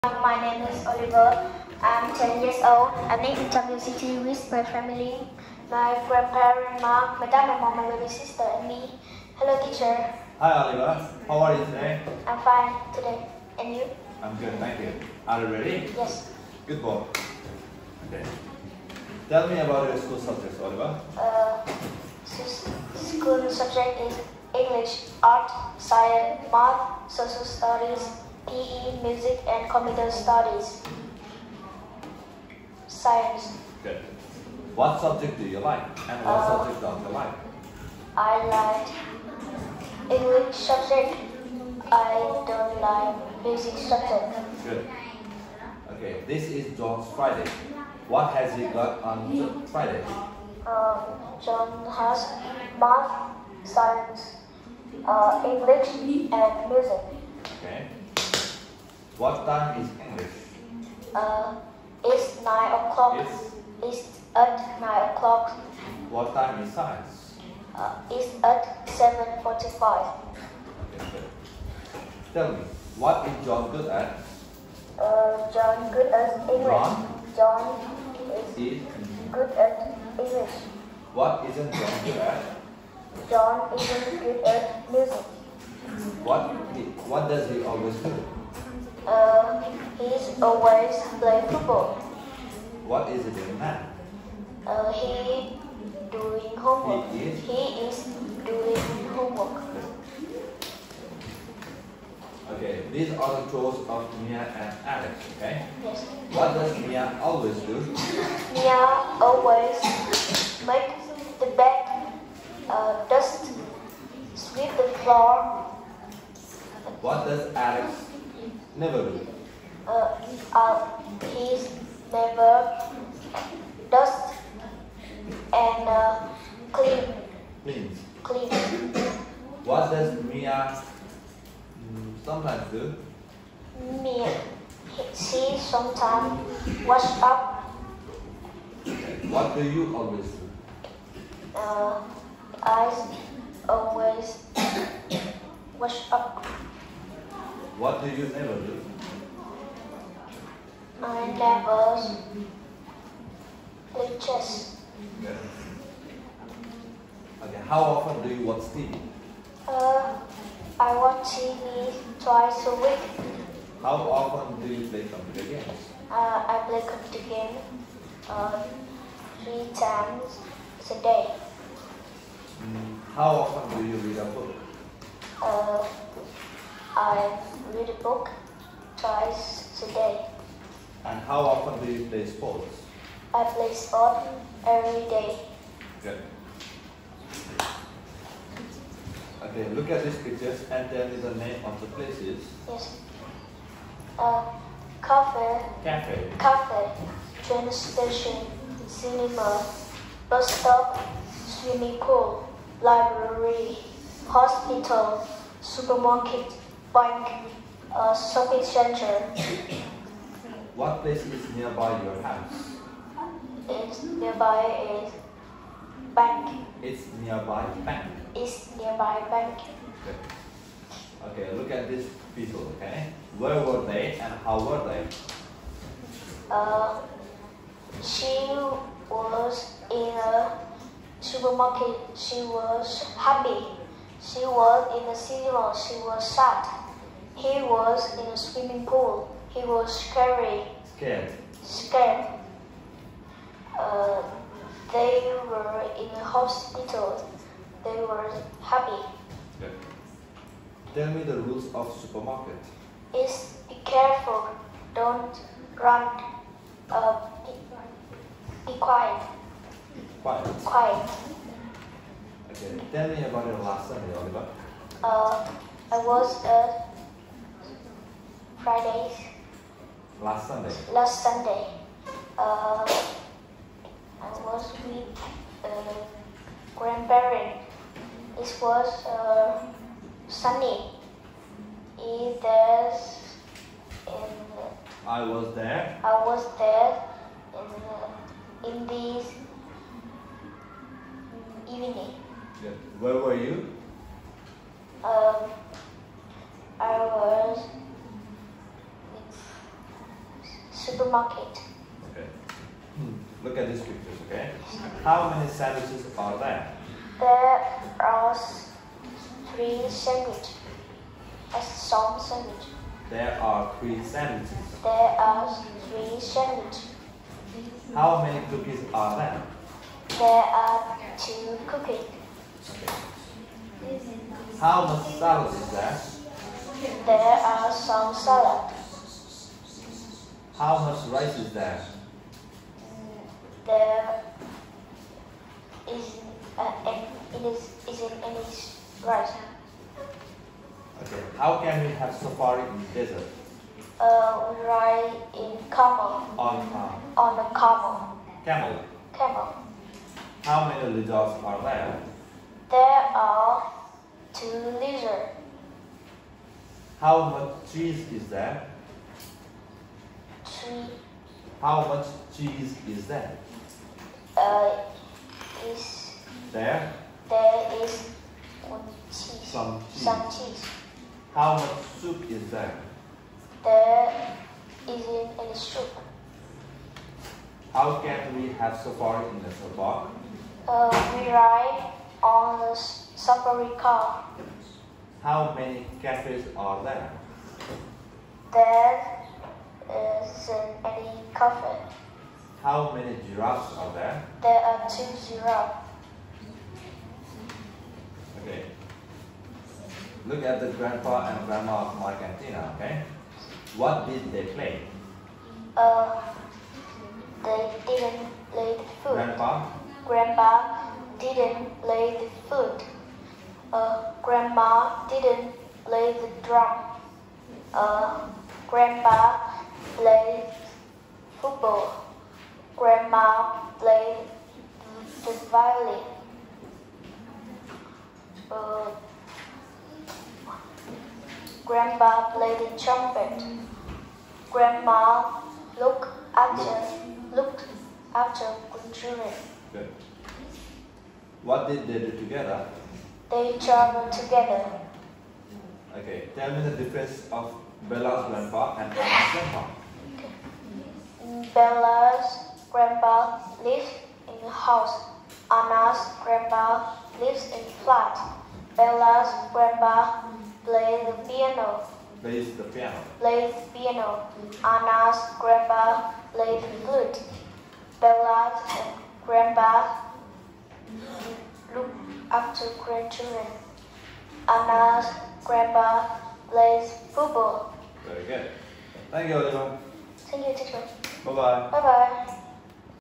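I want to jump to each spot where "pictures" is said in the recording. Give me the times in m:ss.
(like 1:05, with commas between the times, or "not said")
3:10, 5:03.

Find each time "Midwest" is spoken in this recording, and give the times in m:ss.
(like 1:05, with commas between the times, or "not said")
not said.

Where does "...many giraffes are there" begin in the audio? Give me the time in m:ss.
6:32.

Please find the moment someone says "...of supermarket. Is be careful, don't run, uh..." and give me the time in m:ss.
4:11.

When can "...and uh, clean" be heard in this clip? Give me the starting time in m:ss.
2:05.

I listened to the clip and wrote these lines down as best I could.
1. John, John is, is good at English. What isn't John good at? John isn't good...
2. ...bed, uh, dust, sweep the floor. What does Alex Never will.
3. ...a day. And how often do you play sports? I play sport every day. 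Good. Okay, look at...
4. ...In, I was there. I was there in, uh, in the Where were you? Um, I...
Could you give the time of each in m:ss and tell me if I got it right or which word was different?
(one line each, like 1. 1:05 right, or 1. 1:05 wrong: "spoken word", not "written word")
1. 1:17 right
2. 1:51 right
3. 2:59 right
4. 4:44 right.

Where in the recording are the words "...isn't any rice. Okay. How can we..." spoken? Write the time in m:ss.
5:37.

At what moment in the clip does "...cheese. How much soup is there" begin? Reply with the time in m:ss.
6:10.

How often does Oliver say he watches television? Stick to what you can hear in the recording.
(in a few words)
Twice a week.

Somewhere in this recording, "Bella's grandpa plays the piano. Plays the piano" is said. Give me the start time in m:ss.
7:38.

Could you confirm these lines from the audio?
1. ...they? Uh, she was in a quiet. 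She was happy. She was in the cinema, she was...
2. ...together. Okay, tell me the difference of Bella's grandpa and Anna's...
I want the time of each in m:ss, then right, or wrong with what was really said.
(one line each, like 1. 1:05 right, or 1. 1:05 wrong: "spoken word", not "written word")
1. 3:44 wrong: "supermarket", not "quiet"
2. 7:24 right.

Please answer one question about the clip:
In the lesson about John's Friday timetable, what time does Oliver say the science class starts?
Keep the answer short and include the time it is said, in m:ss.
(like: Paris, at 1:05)
7:45, at 1:08.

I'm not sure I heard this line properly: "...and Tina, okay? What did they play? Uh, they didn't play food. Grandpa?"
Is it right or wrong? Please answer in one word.
right.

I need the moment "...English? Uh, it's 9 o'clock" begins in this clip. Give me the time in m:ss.
1:00.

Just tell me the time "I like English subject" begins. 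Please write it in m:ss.
0:38.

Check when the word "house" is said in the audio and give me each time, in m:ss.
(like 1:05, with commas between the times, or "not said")
3:32, 7:34.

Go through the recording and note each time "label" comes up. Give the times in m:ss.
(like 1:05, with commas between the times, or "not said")
not said.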